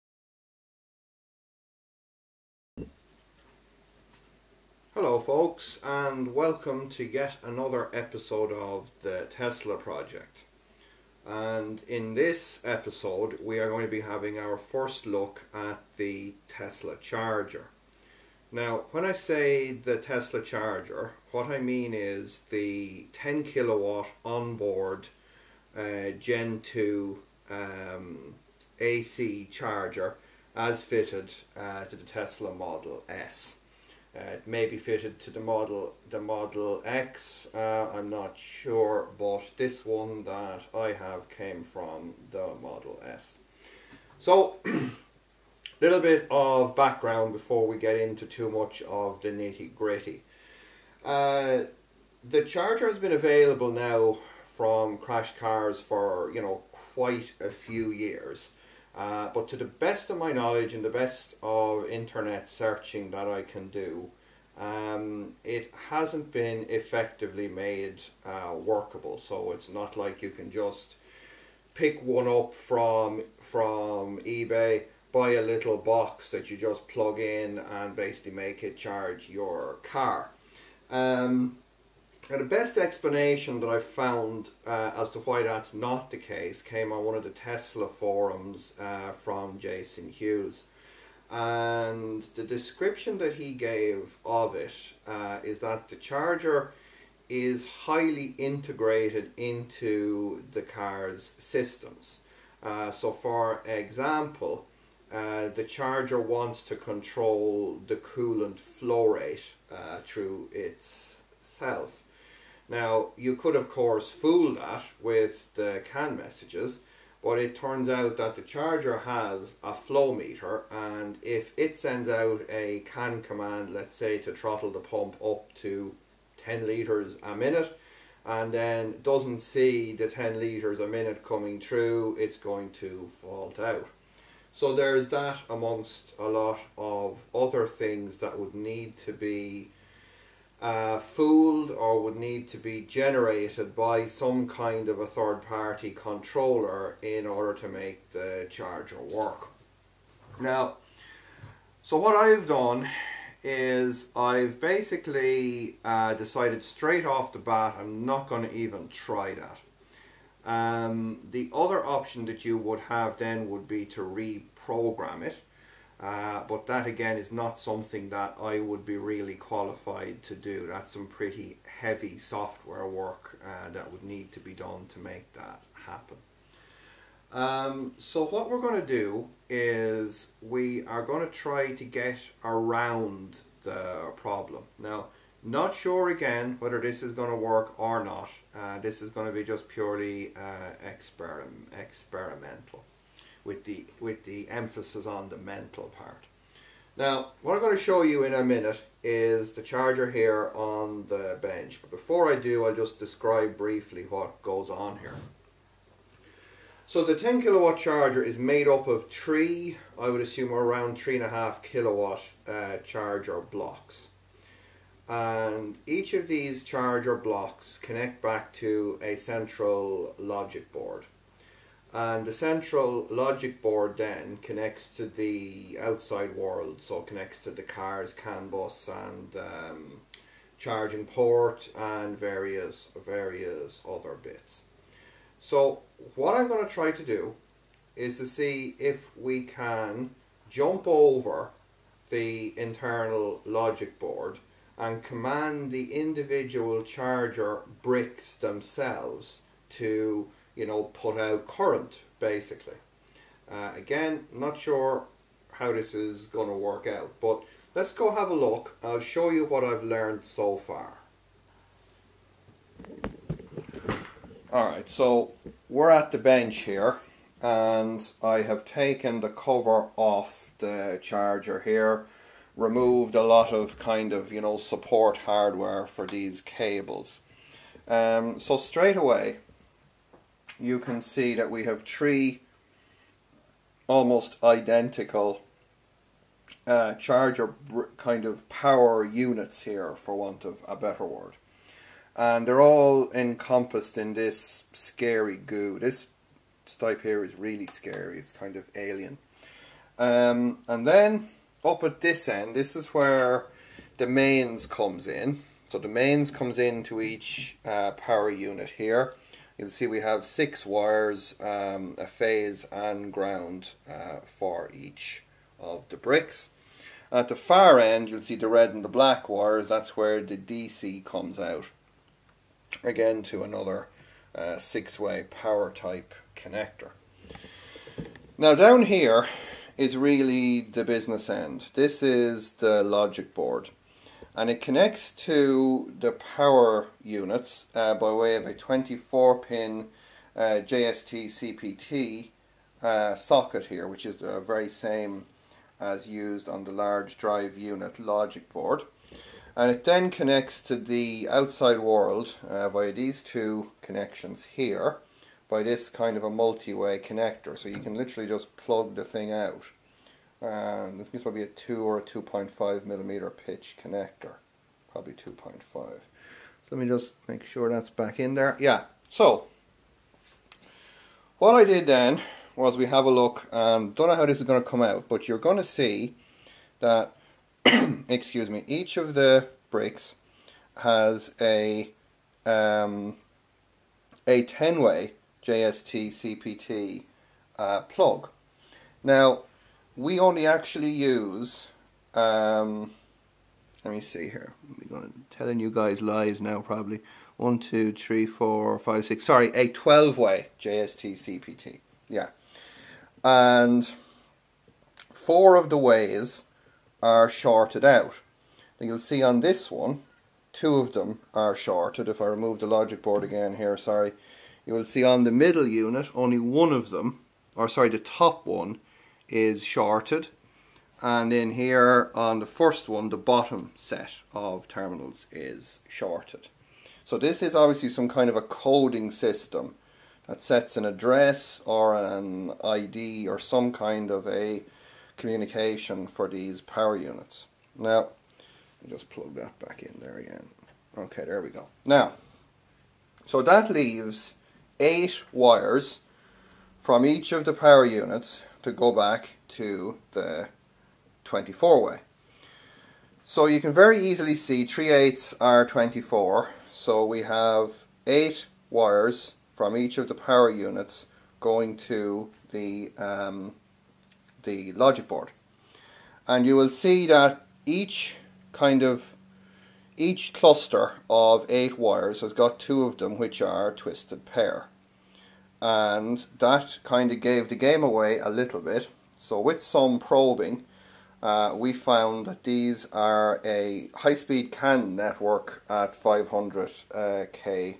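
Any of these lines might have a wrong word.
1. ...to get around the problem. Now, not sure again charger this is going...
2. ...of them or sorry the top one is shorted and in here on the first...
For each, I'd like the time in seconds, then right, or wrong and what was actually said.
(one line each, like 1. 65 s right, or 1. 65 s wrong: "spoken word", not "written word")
1. 181 s wrong: "whether", not "charger"
2. 416 s right.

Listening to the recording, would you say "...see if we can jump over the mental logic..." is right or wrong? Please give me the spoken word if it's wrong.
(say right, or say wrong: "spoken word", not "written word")
wrong: "internal", not "mental".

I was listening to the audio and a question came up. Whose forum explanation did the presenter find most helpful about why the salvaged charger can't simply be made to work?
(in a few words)
Jason Hughes.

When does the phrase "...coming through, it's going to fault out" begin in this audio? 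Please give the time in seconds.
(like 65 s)
131 s.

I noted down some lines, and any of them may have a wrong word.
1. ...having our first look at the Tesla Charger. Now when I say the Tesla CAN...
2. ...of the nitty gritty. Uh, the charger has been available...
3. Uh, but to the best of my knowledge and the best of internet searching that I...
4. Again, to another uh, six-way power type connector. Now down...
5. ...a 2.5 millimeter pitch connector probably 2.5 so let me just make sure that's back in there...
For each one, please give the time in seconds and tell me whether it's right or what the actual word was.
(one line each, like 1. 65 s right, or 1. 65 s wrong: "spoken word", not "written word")
1. 14 s wrong: "Charger", not "CAN"
2. 48 s right
3. 58 s right
4. 322 s right
5. 361 s right.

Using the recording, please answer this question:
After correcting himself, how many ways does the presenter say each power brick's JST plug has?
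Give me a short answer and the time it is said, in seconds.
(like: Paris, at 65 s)
12, at 399 s.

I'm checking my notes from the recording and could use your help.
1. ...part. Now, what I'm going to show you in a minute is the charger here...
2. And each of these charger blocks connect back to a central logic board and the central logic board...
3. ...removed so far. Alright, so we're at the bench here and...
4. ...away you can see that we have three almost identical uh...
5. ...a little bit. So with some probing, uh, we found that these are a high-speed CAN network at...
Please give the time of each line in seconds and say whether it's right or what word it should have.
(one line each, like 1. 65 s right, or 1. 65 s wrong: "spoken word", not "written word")
1. 195 s right
2. 215 s right
3. 259 s wrong: "learned", not "removed"
4. 278 s right
5. 478 s right.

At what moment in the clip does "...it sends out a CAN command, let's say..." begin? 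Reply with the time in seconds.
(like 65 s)
121 s.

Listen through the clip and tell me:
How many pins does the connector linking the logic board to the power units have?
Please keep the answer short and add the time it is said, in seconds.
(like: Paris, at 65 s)
24, at 338 s.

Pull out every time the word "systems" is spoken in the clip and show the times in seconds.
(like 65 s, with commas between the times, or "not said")
101 s, 429 s.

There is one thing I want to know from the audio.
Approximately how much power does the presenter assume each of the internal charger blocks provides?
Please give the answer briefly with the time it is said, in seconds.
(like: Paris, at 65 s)
3.5 kilowatts, at 210 s.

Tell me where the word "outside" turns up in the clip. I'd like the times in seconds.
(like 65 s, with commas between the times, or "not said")
225 s, 351 s.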